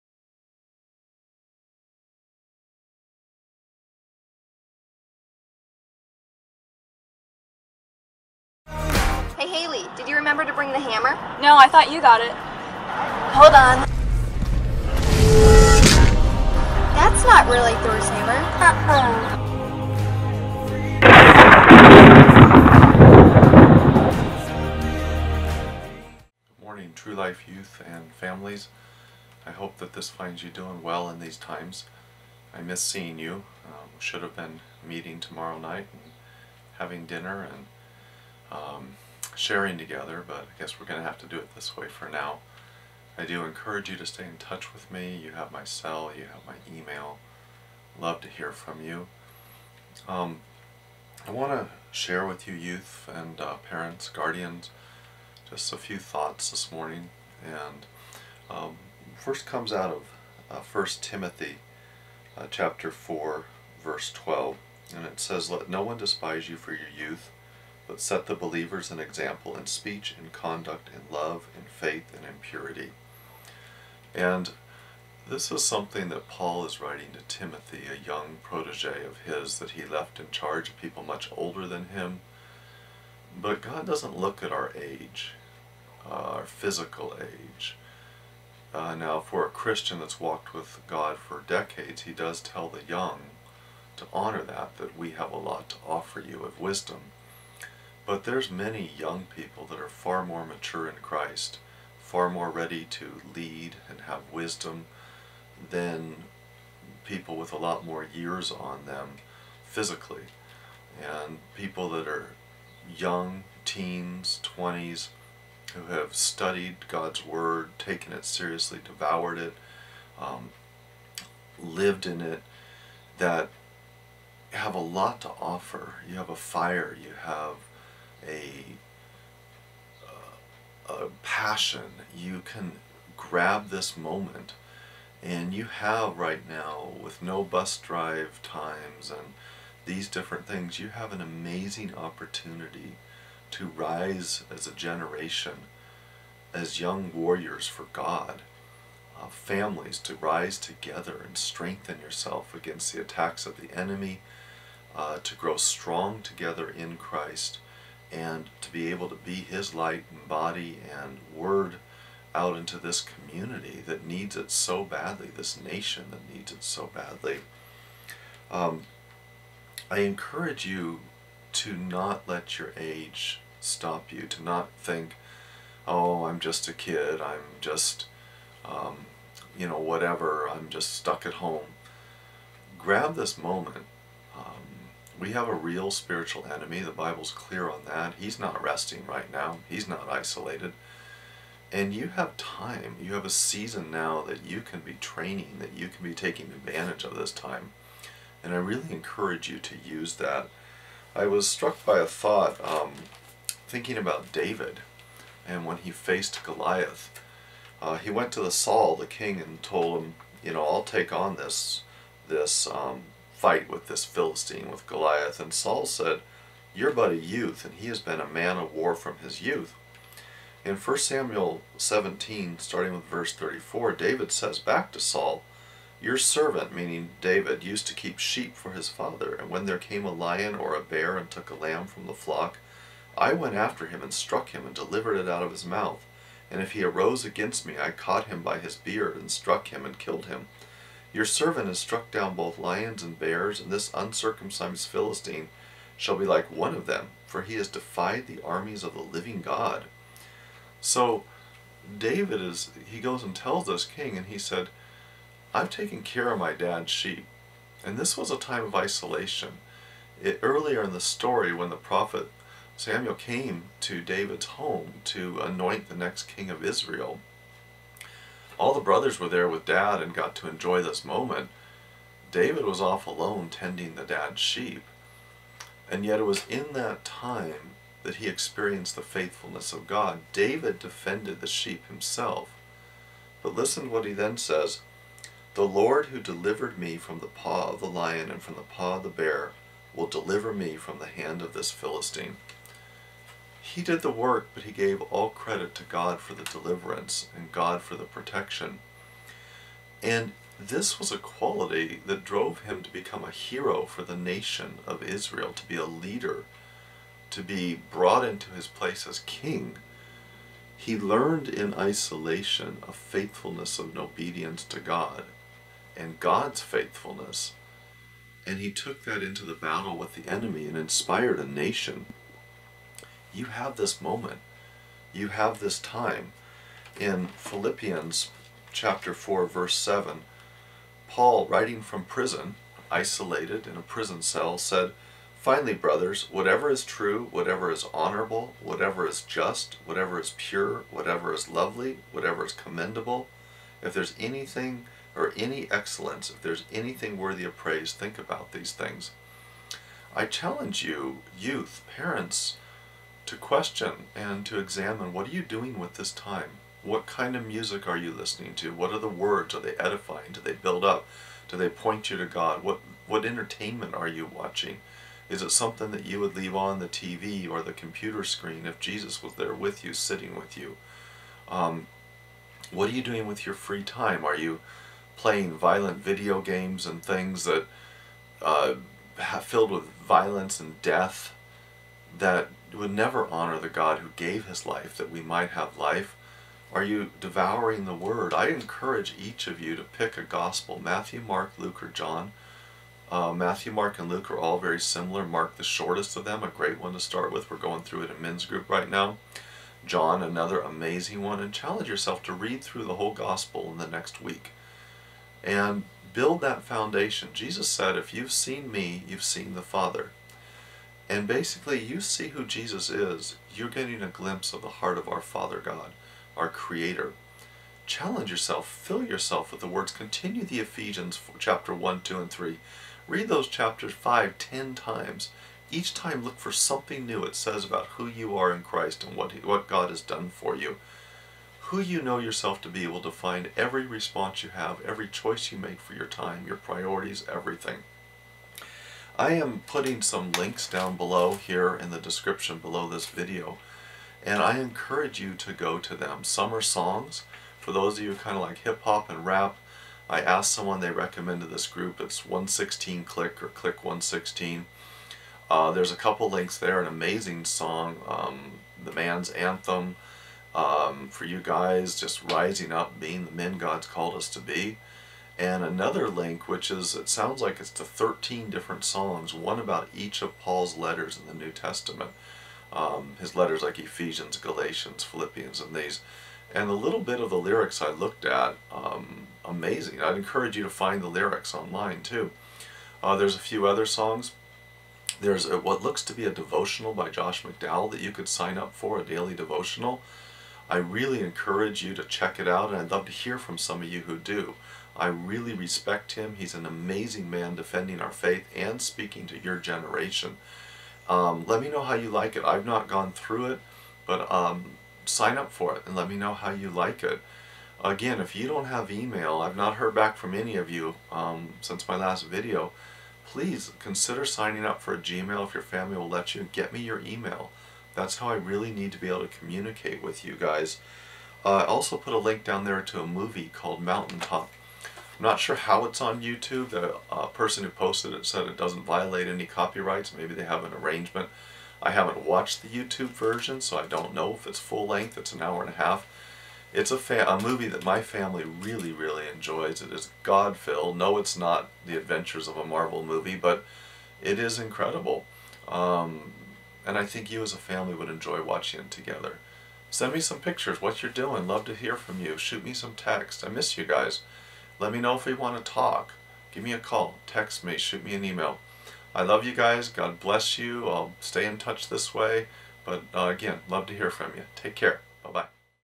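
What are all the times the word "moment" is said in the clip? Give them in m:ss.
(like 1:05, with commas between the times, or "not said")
2:13, 3:03, 4:31, 5:24.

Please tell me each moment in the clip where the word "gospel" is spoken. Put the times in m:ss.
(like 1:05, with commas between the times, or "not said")
6:30, 6:43.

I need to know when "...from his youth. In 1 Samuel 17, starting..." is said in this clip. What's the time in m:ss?
3:38.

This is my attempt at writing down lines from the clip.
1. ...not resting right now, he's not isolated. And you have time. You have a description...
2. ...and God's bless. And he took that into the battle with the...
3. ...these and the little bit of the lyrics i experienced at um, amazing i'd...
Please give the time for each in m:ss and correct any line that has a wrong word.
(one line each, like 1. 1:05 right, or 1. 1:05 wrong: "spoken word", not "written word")
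1. 3:08 wrong: "season", not "description"
2. 5:15 wrong: "faithfulness", not "bless"
3. 7:55 wrong: "looked", not "experienced".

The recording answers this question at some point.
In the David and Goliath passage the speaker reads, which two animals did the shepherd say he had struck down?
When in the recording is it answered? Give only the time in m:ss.
4:02.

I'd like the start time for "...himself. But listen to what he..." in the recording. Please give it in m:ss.
4:41.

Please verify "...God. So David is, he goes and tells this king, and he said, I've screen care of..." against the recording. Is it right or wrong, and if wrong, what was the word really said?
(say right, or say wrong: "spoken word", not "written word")
wrong: "taken", not "screen".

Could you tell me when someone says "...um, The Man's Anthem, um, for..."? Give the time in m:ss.
7:38.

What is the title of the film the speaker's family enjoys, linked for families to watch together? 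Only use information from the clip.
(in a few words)
Mountaintop.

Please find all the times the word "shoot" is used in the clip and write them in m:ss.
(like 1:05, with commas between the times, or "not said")
9:12, 9:17.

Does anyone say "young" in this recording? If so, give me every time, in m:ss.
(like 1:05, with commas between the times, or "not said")
1:18, 1:32, 1:38, 1:52, 2:26.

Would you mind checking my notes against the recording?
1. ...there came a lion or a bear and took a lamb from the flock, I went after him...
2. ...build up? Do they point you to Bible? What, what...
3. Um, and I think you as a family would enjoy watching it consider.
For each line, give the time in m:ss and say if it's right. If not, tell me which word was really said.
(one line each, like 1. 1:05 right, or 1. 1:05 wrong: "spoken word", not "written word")
1. 3:49 right
2. 6:00 wrong: "God", not "Bible"
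3. 9:05 wrong: "together", not "consider".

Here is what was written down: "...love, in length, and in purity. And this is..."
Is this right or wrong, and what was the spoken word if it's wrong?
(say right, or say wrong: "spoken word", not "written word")
wrong: "faith", not "length".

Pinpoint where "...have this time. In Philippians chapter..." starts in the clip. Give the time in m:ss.
5:25.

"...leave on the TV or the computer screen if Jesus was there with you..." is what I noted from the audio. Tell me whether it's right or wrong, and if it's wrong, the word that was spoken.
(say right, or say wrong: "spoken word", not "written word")
right.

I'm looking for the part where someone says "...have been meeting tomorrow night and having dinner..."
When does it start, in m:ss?
0:34.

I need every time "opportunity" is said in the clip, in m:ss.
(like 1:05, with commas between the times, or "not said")
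2:21.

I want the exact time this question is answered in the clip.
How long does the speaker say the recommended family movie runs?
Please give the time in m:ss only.
8:55.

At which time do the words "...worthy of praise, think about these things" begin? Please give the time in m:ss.
5:47.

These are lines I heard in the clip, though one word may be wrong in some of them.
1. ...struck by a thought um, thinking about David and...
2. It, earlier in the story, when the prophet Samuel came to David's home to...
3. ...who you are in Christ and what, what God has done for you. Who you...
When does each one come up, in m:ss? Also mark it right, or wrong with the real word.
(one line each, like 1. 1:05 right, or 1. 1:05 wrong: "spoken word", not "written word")
1. 3:21 right
2. 4:20 right
3. 7:07 right.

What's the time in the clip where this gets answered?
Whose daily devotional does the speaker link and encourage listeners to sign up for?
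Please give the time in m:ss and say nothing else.
8:07.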